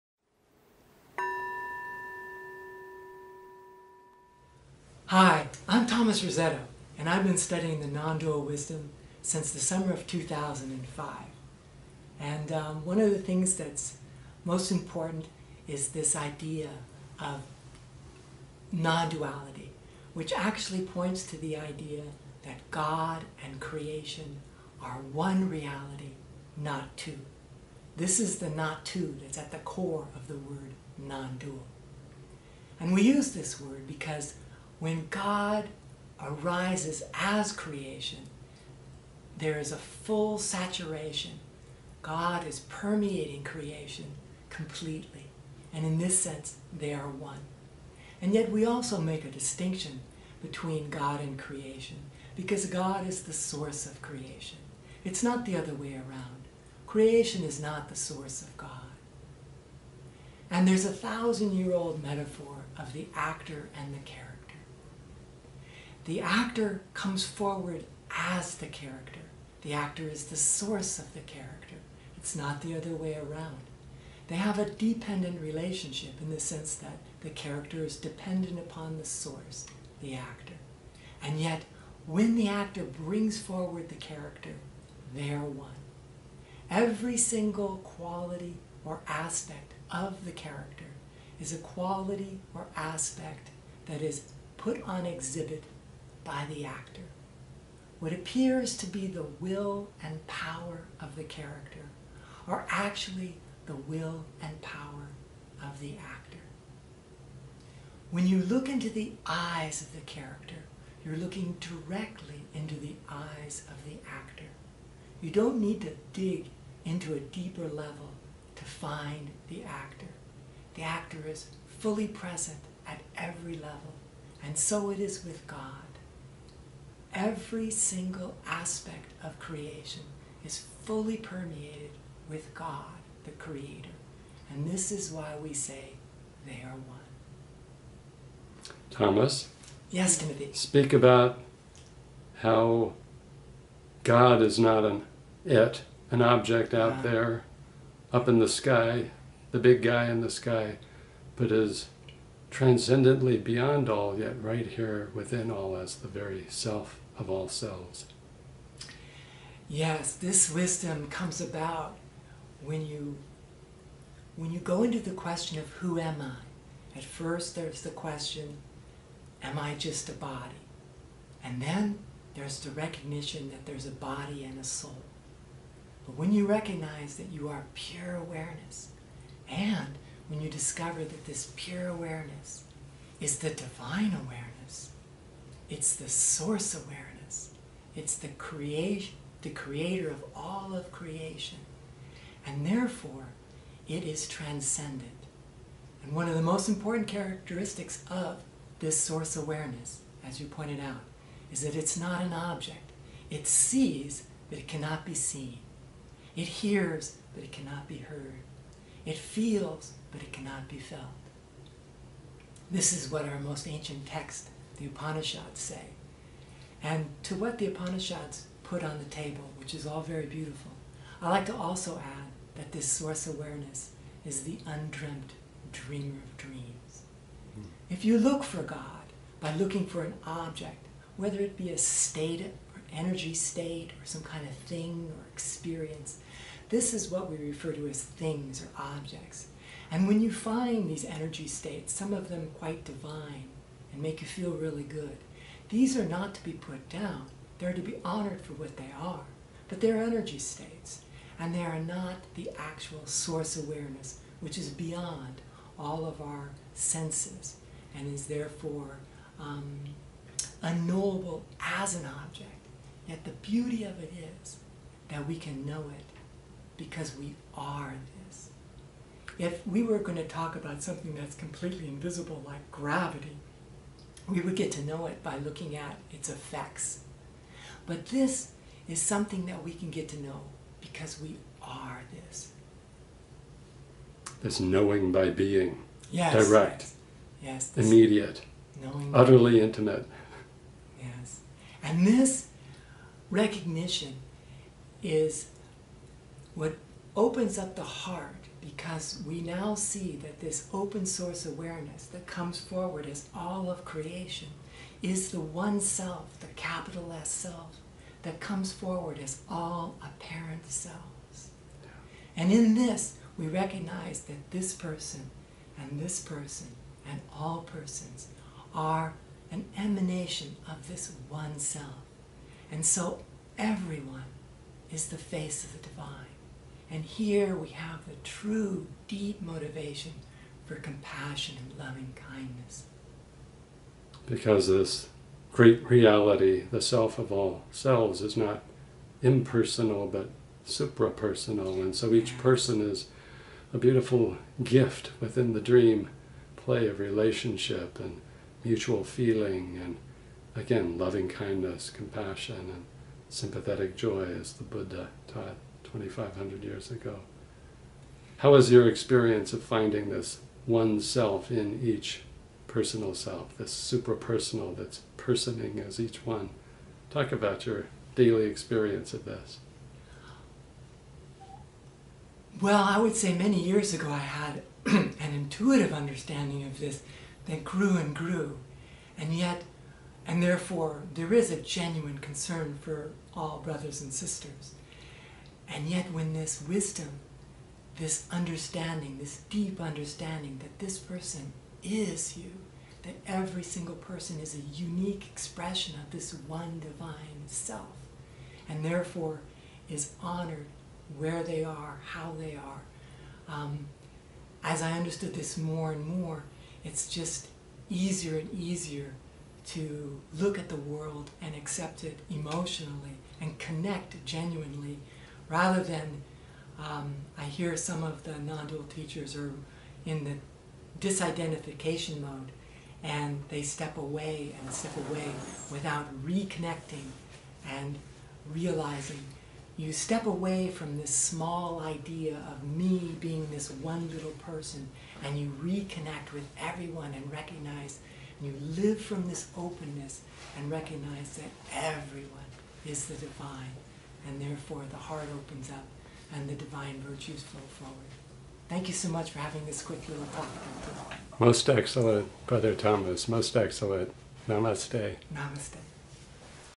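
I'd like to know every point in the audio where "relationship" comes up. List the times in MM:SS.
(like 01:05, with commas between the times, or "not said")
01:15, 05:46.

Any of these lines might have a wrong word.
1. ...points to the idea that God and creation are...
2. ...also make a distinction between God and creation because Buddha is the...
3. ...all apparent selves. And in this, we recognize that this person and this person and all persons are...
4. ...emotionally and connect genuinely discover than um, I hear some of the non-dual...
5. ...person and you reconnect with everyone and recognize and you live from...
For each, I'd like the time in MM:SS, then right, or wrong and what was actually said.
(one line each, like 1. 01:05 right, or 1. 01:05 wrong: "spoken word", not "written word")
1. 00:20 right
2. 00:48 wrong: "God", not "Buddha"
3. 05:09 right
4. 06:52 wrong: "rather", not "discover"
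5. 07:14 right.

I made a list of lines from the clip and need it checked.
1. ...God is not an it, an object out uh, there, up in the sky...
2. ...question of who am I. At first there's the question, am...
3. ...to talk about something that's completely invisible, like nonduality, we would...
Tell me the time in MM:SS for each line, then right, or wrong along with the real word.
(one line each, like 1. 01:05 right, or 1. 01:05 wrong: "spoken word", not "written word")
1. 02:24 right
2. 02:45 right
3. 04:30 wrong: "gravity", not "nonduality".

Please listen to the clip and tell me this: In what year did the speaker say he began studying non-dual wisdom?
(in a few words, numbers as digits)
2005.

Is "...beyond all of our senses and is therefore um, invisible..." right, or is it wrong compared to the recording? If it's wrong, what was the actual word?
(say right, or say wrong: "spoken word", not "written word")
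wrong: "unknowable", not "invisible".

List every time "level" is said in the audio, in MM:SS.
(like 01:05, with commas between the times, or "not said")
01:57, 02:03.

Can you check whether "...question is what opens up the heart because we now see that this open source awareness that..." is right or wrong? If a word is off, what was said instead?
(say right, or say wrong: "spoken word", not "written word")
wrong: "recognition", not "question".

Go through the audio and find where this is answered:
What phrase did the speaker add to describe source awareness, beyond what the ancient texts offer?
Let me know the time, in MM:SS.
03:44.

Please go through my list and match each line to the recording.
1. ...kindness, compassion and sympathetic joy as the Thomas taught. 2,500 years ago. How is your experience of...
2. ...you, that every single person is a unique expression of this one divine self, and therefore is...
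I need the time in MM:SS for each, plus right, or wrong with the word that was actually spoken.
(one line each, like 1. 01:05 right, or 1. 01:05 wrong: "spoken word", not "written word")
1. 05:51 wrong: "Buddha", not "Thomas"
2. 06:32 right.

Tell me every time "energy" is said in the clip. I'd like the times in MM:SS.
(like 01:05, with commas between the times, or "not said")
03:52, 04:01, 04:10.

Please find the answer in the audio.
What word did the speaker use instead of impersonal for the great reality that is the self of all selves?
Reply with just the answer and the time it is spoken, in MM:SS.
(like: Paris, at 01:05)
suprapersonal, at 05:40.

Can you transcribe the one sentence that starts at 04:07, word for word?
They're to be honored for what they are.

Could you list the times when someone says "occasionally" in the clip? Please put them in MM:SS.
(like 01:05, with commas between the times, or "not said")
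not said.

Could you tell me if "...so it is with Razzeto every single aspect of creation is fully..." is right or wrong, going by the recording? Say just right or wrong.
wrong.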